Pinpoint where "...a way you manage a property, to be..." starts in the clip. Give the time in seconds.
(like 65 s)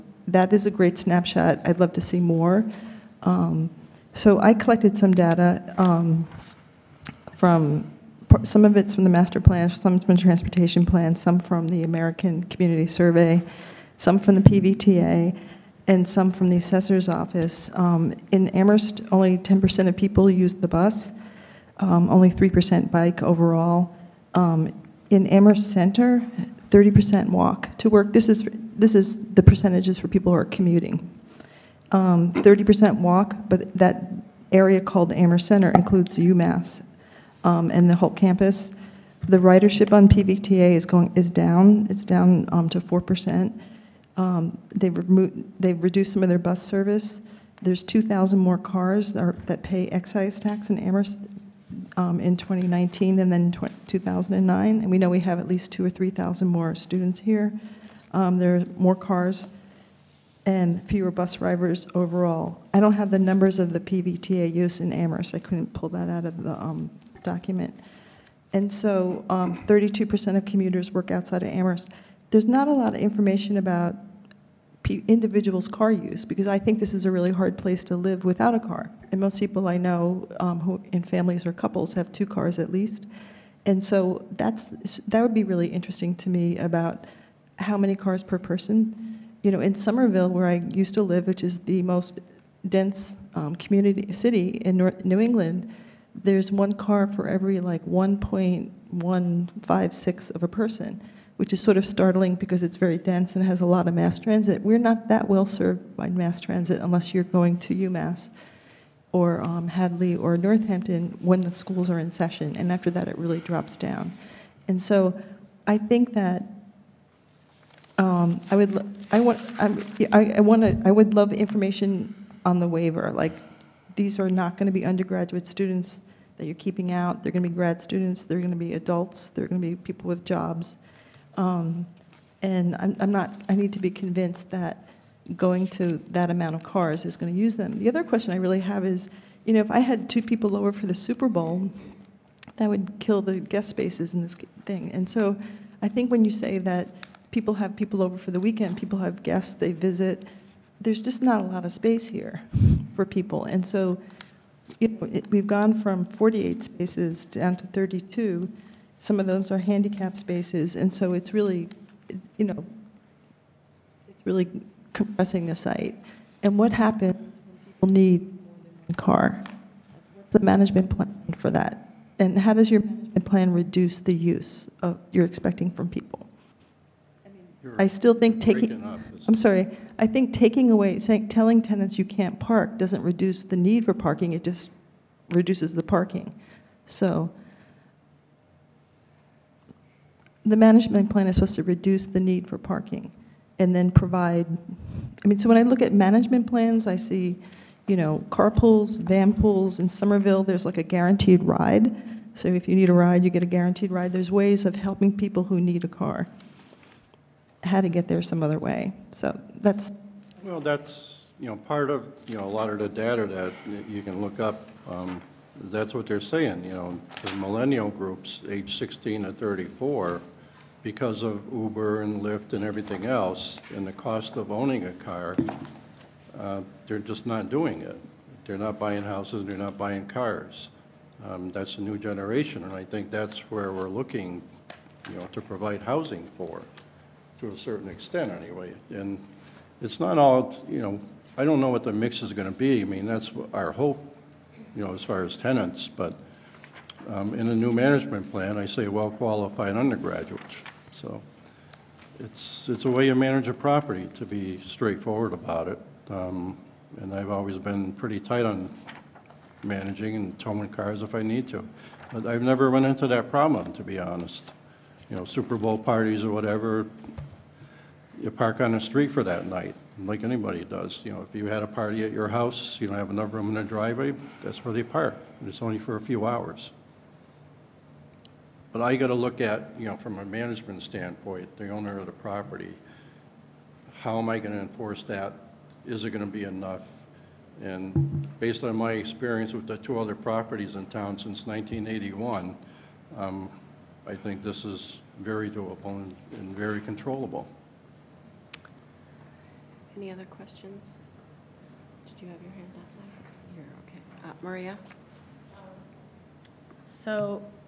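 252 s.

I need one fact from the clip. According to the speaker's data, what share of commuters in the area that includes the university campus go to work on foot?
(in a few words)
30%.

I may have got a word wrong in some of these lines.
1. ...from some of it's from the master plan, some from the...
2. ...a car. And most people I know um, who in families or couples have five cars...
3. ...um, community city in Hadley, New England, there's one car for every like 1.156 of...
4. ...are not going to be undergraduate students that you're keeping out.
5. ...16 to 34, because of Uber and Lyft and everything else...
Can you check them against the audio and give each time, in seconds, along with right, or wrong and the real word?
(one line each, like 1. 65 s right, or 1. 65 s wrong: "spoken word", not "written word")
1. 7 s right
2. 78 s wrong: "two", not "five"
3. 93 s wrong: "North", not "Hadley"
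4. 124 s right
5. 218 s right.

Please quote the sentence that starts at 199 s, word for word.
In Somerville, there's like a guaranteed ride.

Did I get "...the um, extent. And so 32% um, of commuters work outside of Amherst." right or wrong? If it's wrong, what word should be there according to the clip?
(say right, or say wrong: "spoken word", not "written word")
wrong: "document", not "extent".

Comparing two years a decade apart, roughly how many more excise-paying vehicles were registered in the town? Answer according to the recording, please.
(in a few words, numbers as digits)
2,000.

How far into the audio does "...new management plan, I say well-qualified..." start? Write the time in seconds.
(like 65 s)
247 s.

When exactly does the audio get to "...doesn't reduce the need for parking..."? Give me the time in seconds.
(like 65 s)
182 s.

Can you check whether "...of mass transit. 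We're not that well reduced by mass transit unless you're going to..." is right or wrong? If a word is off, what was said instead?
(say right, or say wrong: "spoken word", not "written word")
wrong: "served", not "reduced".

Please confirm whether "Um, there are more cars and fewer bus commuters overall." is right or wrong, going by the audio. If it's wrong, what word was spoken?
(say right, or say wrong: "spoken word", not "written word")
wrong: "drivers", not "commuters".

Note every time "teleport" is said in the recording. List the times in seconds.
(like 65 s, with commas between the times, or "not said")
not said.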